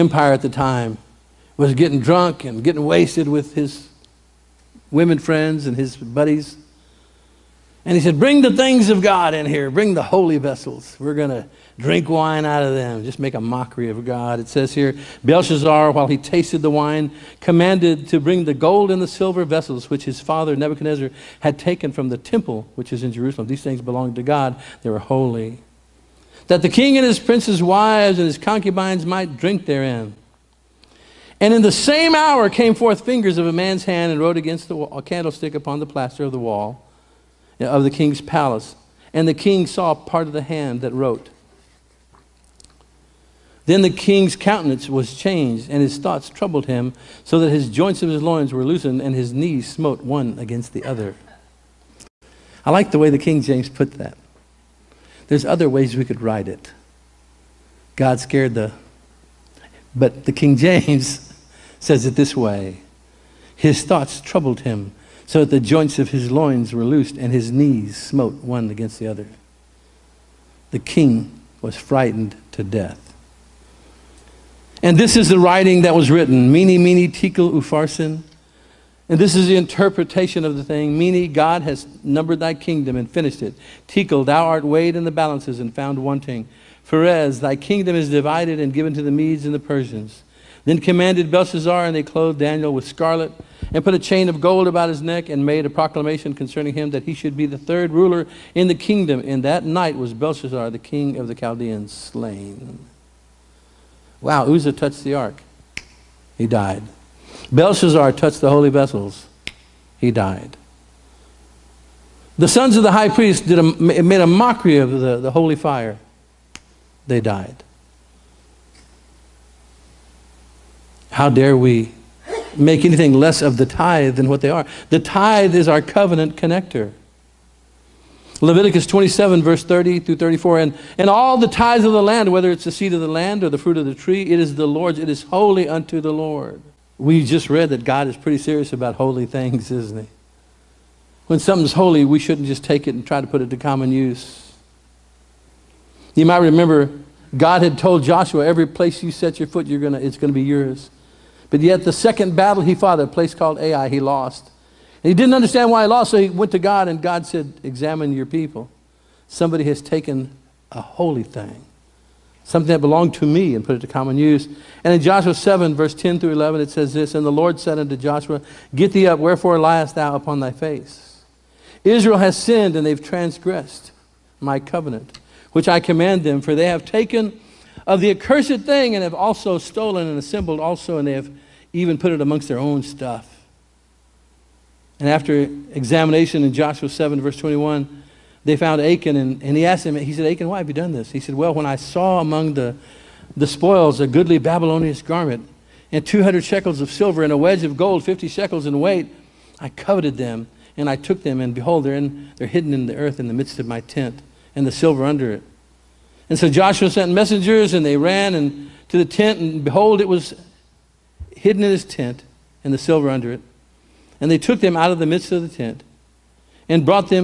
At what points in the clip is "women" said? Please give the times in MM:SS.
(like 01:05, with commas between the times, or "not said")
00:04.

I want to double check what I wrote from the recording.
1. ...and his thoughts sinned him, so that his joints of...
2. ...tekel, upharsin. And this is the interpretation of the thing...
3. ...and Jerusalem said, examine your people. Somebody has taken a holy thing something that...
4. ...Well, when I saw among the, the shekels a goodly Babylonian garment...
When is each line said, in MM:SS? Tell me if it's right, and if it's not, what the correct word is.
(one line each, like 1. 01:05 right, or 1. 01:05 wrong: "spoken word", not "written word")
1. 00:45 wrong: "troubled", not "sinned"
2. 01:17 right
3. 02:36 wrong: "God", not "Jerusalem"
4. 03:11 wrong: "spoils", not "shekels".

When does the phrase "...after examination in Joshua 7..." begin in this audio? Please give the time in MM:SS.
03:05.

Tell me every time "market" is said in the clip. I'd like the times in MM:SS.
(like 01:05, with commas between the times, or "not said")
not said.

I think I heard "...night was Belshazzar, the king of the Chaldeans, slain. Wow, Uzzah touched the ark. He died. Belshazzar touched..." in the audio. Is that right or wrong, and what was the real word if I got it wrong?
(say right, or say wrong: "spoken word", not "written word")
right.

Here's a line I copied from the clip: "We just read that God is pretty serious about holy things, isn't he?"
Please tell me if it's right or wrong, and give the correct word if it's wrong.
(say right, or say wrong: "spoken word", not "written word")
right.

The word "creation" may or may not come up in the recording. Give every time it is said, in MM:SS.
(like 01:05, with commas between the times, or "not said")
not said.